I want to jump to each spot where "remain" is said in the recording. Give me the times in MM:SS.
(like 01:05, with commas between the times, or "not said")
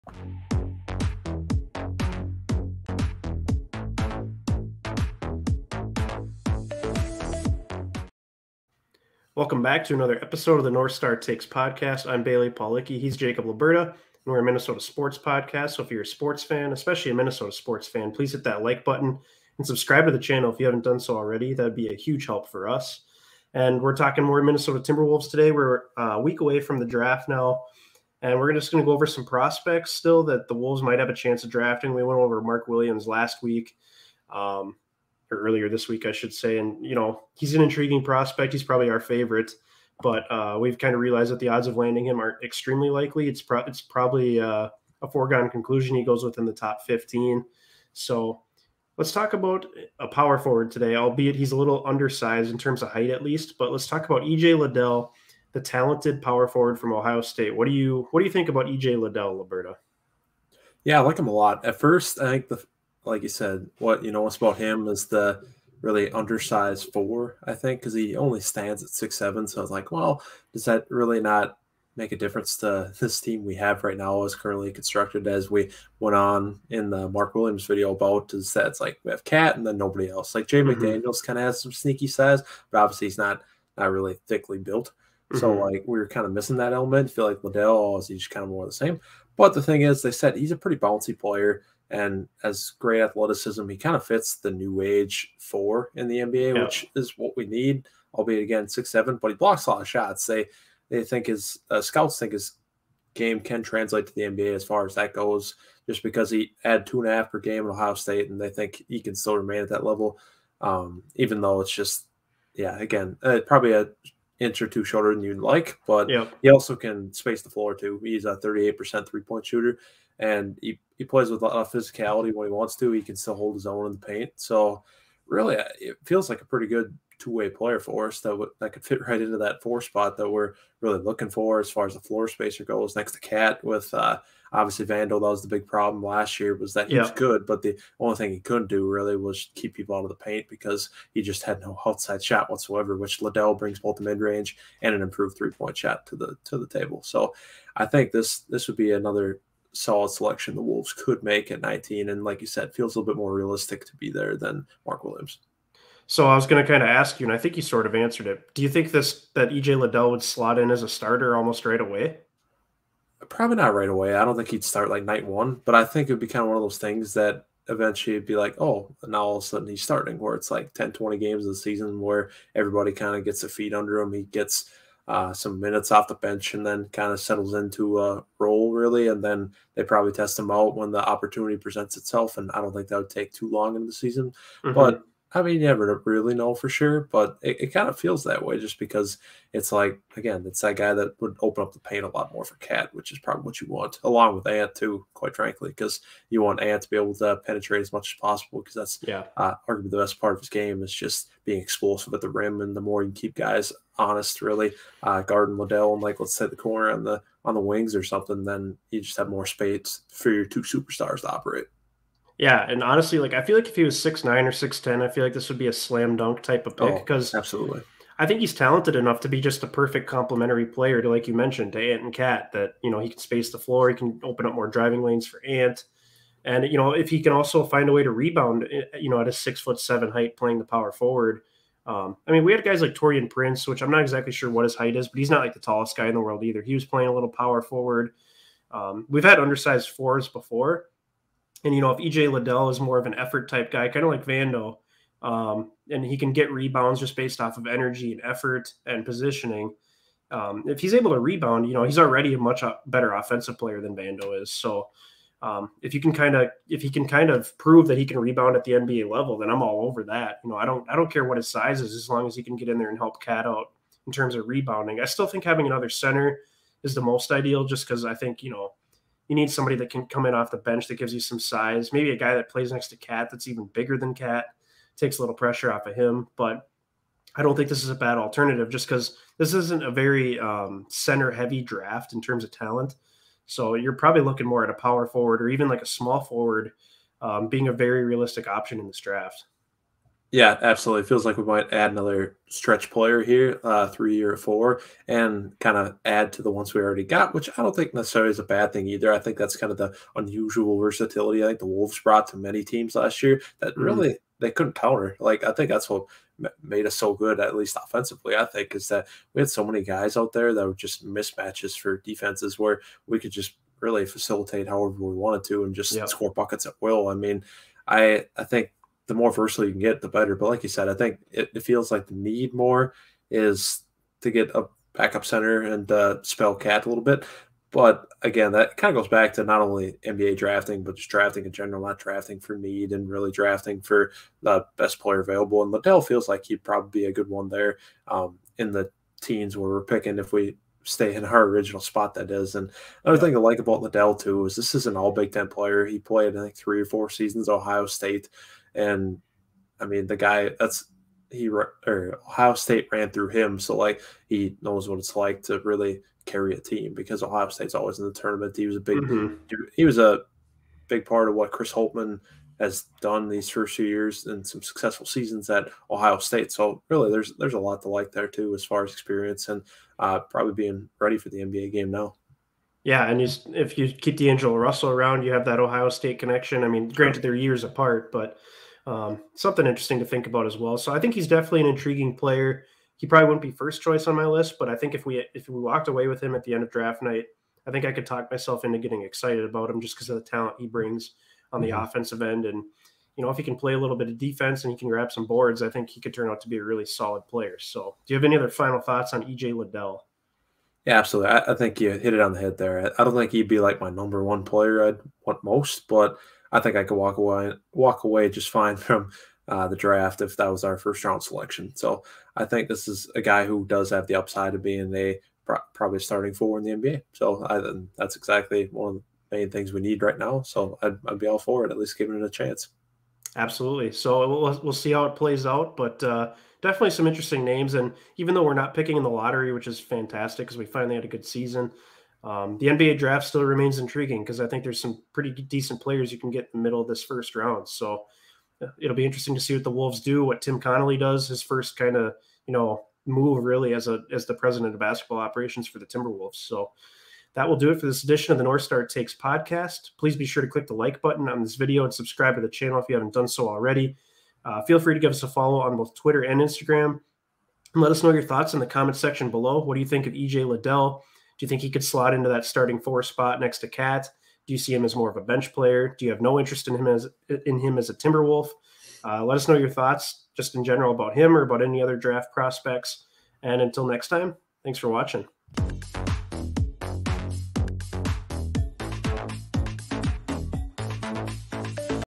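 01:49, 07:13.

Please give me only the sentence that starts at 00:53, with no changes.
But let's talk about EJ Liddell, the talented power forward from Ohio State.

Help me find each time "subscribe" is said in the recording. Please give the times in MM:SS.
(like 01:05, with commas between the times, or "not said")
00:19, 07:31.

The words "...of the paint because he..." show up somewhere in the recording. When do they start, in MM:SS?
02:20.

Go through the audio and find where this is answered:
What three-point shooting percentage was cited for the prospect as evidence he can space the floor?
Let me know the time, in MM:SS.
01:58.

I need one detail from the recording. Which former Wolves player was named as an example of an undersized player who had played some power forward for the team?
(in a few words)
Taurean Prince.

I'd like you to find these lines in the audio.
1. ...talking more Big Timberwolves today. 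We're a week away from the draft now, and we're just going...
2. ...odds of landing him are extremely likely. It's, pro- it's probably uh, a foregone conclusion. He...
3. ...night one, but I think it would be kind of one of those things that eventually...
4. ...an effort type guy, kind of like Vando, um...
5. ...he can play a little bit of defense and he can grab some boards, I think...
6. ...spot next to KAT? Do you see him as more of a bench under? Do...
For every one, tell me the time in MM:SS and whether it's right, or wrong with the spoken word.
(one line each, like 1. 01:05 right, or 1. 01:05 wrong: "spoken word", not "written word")
1. 00:23 wrong: "Minnesota", not "Big"
2. 00:41 right
3. 02:45 right
4. 04:03 right
5. 06:33 right
6. 07:43 wrong: "player", not "under".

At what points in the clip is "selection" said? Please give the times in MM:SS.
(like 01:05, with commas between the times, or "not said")
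02:30, 06:51.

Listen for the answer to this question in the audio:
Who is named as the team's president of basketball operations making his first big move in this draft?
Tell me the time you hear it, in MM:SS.
07:20.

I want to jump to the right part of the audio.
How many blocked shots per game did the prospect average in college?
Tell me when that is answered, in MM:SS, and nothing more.
01:46.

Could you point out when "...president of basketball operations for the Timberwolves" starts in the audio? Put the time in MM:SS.
07:24.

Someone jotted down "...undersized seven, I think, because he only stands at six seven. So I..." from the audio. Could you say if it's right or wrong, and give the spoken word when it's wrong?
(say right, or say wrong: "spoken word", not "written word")
wrong: "four", not "seven".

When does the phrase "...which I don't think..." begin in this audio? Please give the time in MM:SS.
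04:57.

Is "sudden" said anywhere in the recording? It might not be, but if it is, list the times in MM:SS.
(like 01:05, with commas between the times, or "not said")
02:49.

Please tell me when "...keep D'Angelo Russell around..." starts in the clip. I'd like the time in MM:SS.
06:13.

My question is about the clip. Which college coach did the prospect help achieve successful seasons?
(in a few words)
Chris Holtmann.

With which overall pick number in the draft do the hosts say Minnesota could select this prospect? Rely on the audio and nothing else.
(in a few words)
19.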